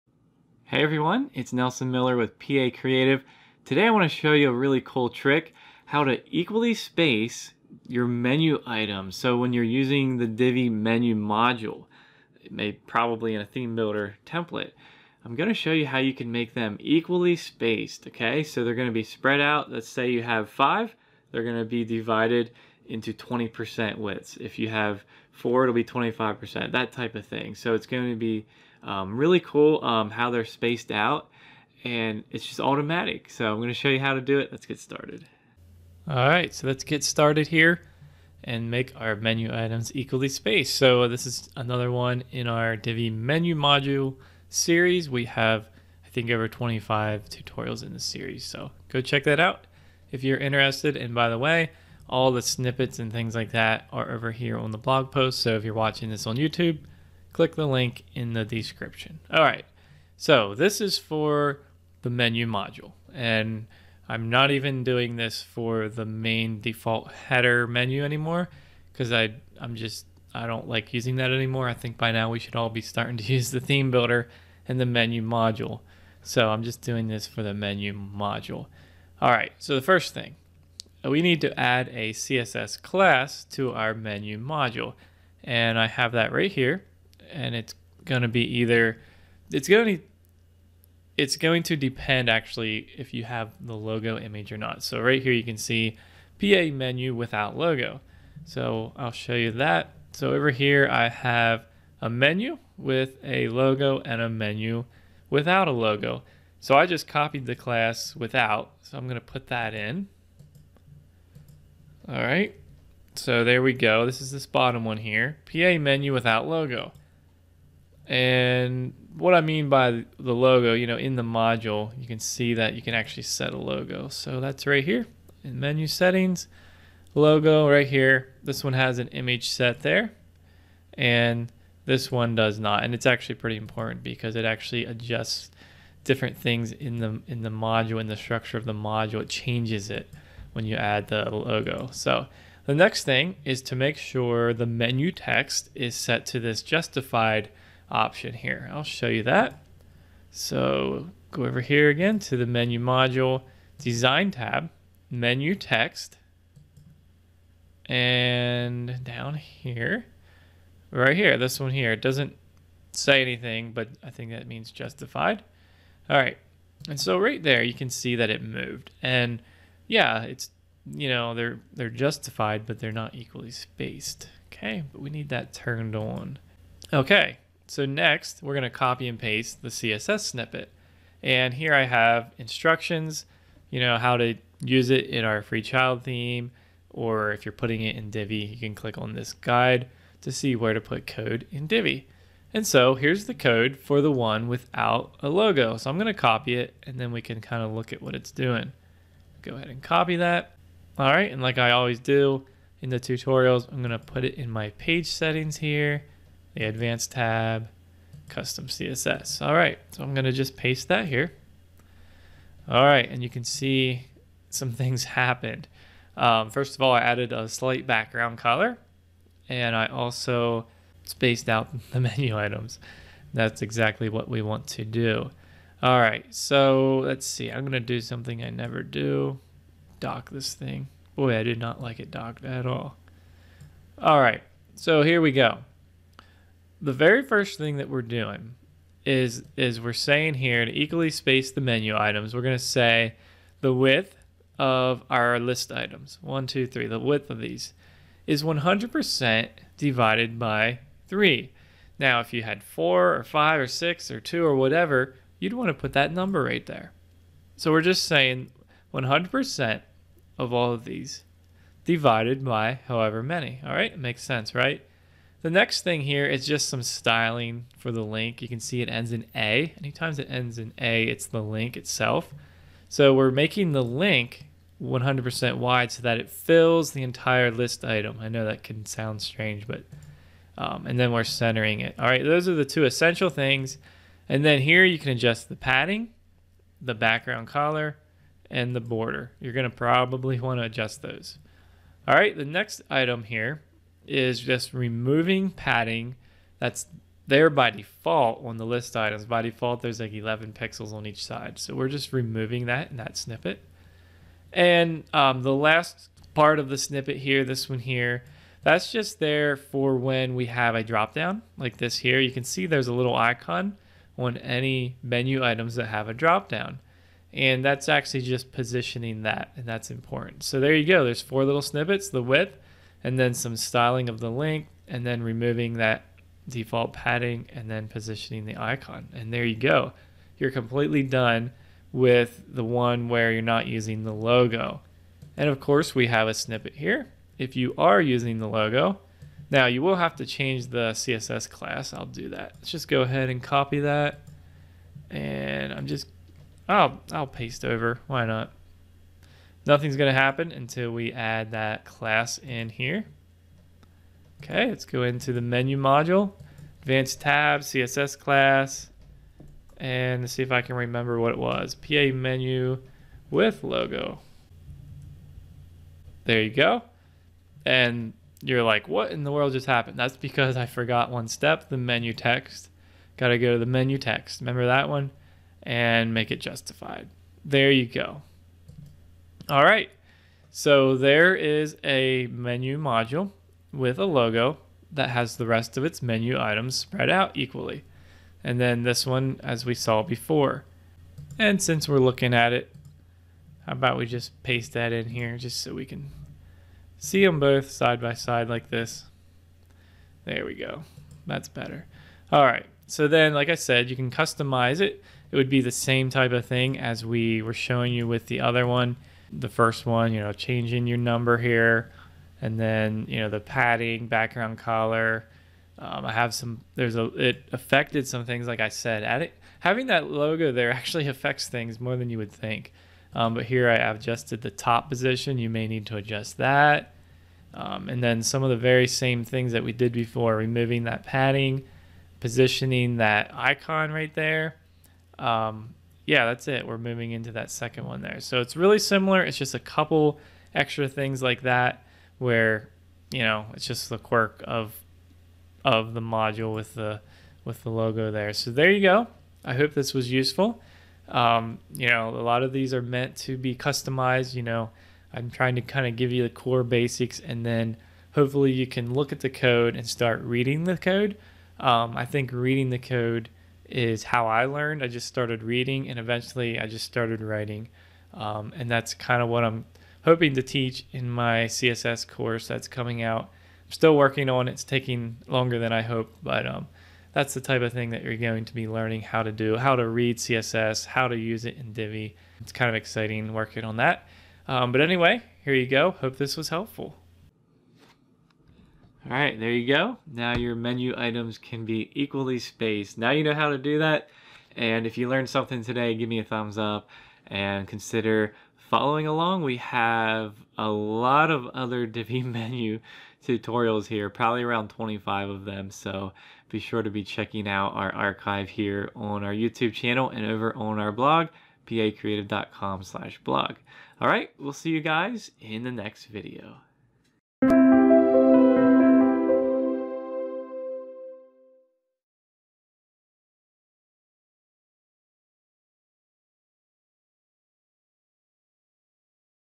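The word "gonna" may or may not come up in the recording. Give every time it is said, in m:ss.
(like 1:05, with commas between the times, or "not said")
1:49, 3:30, 3:47, 4:49.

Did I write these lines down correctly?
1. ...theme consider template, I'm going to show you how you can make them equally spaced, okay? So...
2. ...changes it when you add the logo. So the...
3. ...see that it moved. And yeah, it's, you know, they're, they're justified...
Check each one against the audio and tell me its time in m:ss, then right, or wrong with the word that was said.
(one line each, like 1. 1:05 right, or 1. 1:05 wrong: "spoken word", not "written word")
1. 0:13 wrong: "builder", not "consider"
2. 2:19 right
3. 2:47 right.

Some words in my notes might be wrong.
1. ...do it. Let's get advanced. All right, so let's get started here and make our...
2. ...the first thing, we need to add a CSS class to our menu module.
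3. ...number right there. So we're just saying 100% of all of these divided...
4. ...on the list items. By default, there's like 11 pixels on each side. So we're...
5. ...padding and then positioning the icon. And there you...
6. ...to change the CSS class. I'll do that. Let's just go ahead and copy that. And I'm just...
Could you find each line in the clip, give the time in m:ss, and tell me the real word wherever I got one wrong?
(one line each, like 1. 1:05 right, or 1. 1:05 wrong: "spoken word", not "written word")
1. 0:34 wrong: "started", not "advanced"
2. 1:19 right
3. 4:16 right
4. 4:58 right
5. 5:26 right
6. 5:40 right.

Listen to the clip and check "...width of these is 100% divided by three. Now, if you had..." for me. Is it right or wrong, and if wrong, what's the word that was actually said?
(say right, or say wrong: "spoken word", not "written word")
right.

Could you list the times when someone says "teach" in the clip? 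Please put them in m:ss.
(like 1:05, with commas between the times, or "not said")
7:50.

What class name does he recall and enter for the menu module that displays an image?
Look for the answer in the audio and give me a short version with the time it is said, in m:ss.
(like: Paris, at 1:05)
PA menu with logo, at 6:01.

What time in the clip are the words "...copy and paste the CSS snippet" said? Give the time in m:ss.
2:58.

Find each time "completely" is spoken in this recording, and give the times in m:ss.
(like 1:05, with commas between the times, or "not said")
5:30.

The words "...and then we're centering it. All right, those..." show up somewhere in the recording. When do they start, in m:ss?
4:40.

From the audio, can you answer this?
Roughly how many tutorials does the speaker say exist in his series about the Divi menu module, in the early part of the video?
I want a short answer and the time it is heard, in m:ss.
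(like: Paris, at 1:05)
over 25, at 0:46.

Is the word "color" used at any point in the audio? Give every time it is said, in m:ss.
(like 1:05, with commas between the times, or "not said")
3:38, 4:47, 6:54.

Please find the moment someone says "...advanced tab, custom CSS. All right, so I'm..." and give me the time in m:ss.
3:26.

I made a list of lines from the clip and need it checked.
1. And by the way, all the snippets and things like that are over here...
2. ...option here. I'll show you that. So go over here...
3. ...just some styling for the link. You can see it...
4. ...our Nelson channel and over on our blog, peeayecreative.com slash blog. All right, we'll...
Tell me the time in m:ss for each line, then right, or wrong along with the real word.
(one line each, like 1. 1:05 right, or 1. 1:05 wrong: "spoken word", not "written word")
1. 0:50 right
2. 2:27 right
3. 4:26 right
4. 8:29 wrong: "YouTube", not "Nelson".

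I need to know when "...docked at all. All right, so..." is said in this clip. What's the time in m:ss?
3:52.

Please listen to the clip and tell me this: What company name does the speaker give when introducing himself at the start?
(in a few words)
Pee-Aye Creative.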